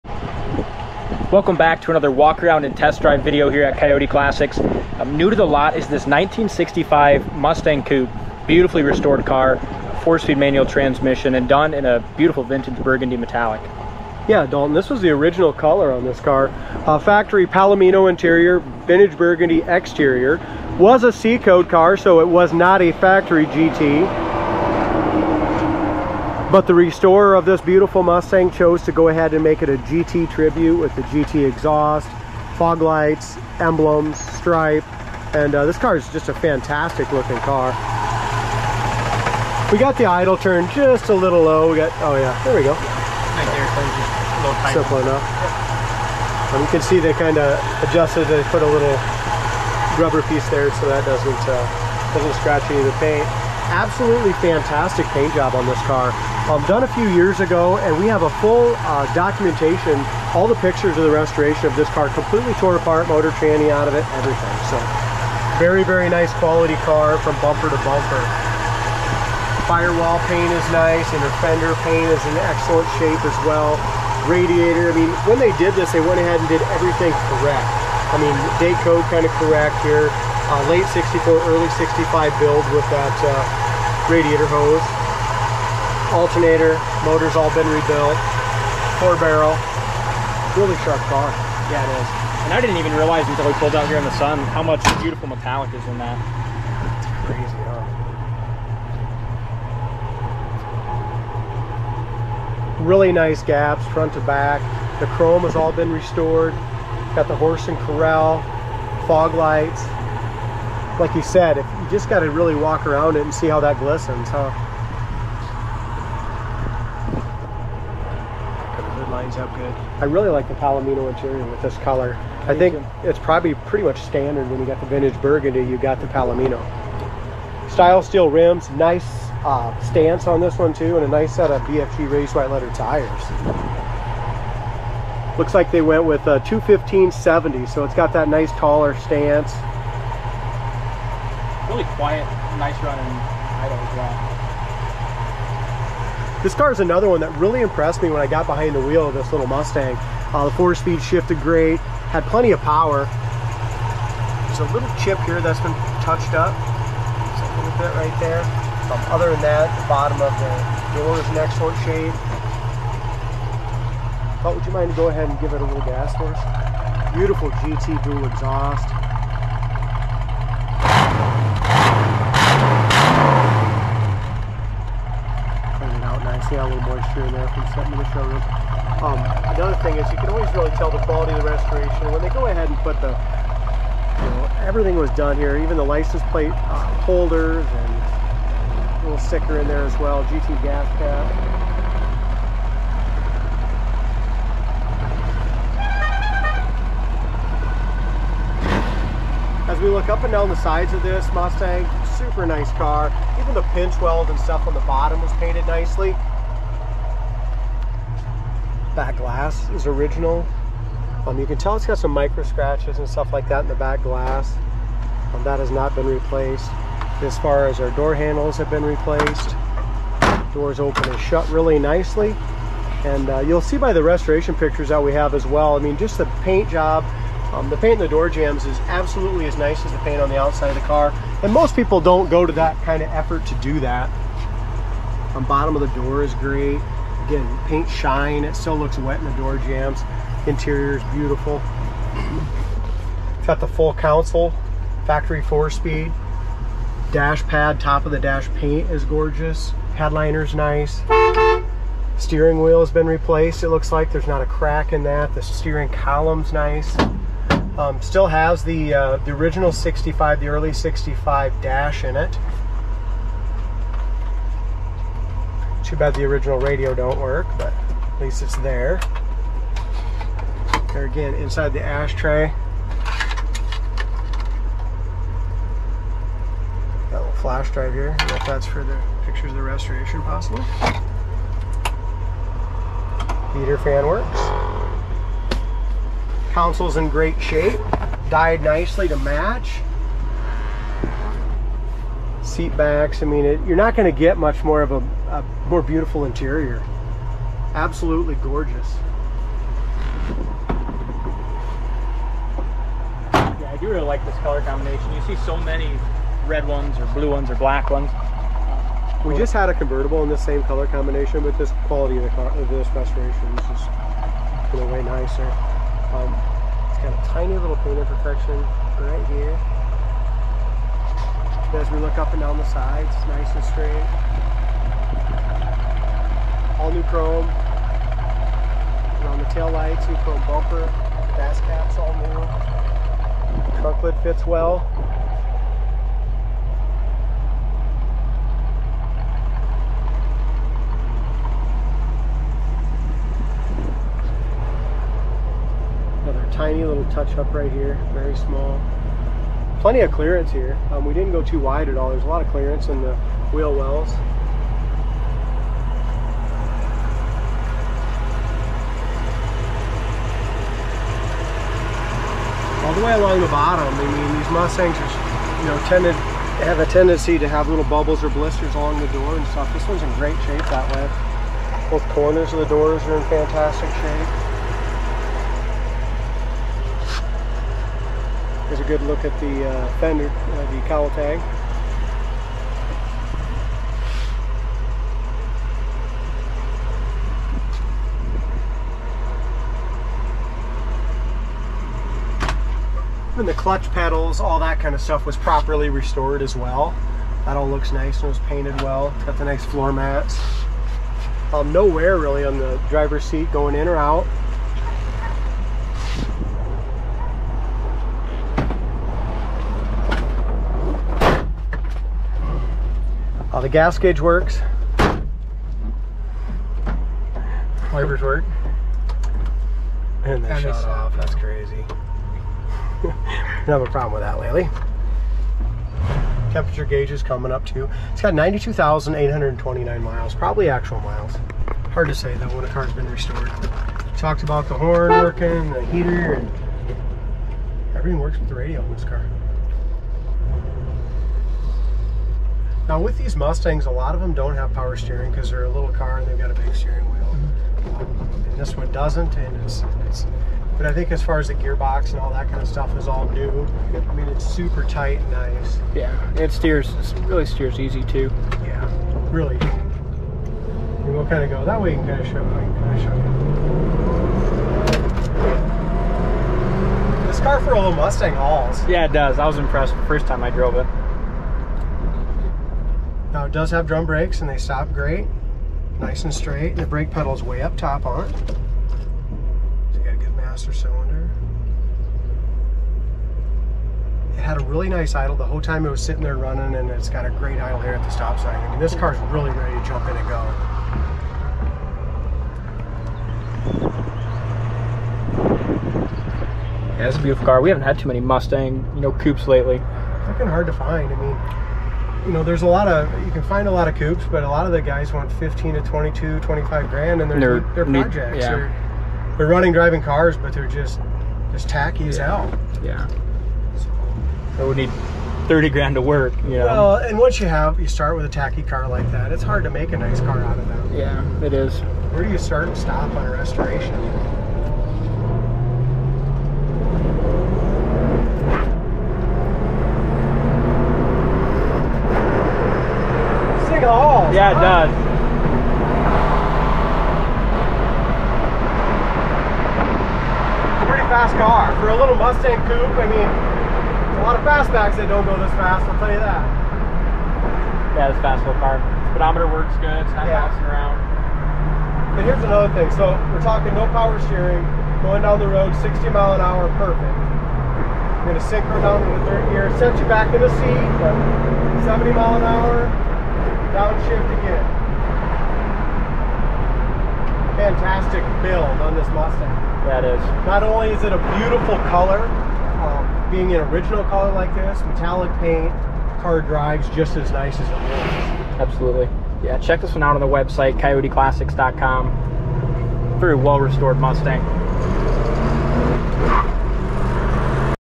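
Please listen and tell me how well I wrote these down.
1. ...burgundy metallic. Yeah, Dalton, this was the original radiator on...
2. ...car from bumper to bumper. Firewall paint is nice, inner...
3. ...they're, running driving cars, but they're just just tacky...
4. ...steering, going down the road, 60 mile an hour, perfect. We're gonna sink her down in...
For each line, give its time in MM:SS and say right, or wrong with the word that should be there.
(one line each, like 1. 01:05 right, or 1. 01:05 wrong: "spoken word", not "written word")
1. 00:12 wrong: "color", not "radiator"
2. 01:06 right
3. 08:29 right
4. 09:14 right.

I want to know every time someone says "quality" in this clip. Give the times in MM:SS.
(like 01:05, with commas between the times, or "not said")
01:06, 03:00, 05:11.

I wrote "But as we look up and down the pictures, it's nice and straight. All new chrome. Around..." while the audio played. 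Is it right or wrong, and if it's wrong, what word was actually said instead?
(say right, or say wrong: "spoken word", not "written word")
wrong: "sides", not "pictures".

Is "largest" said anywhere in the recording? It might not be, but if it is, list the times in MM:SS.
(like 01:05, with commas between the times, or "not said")
not said.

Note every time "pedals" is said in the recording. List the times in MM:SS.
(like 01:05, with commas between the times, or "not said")
06:33, 07:57.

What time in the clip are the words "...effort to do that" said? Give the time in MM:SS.
03:53.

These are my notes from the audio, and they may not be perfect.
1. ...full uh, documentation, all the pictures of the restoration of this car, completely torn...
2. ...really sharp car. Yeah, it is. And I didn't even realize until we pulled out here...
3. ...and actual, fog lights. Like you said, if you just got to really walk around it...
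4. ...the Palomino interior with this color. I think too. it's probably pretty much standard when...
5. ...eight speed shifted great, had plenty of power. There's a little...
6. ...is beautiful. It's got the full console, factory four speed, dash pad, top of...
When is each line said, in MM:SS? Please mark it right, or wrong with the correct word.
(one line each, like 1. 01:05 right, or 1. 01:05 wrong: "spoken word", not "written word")
1. 00:58 right
2. 01:30 right
3. 01:47 wrong: "corral", not "actual"
4. 02:00 right
5. 02:30 wrong: "four", not "eight"
6. 04:00 right.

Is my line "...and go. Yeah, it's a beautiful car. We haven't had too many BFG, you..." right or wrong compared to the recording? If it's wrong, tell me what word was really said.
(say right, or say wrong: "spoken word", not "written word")
wrong: "Mustang", not "BFG".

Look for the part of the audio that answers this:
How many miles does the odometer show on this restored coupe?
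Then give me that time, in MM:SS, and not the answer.
07:08.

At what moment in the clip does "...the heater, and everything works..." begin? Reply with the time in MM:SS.
07:15.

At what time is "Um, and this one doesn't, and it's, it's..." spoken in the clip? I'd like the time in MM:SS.
07:27.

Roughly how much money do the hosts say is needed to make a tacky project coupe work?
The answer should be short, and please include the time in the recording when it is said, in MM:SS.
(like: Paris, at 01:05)
30 grand, at 08:35.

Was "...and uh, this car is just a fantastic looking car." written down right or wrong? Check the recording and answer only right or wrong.
right.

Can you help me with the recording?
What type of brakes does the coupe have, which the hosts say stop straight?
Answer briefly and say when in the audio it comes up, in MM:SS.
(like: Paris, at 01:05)
Drum brakes, at 07:53.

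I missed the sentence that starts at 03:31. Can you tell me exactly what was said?
Um, you can tell it's got some micro scratches and stuff like that in the back glass.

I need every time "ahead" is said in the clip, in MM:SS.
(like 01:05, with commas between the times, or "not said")
00:29, 01:16, 02:45, 03:02.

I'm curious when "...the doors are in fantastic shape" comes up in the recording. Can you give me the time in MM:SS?
06:12.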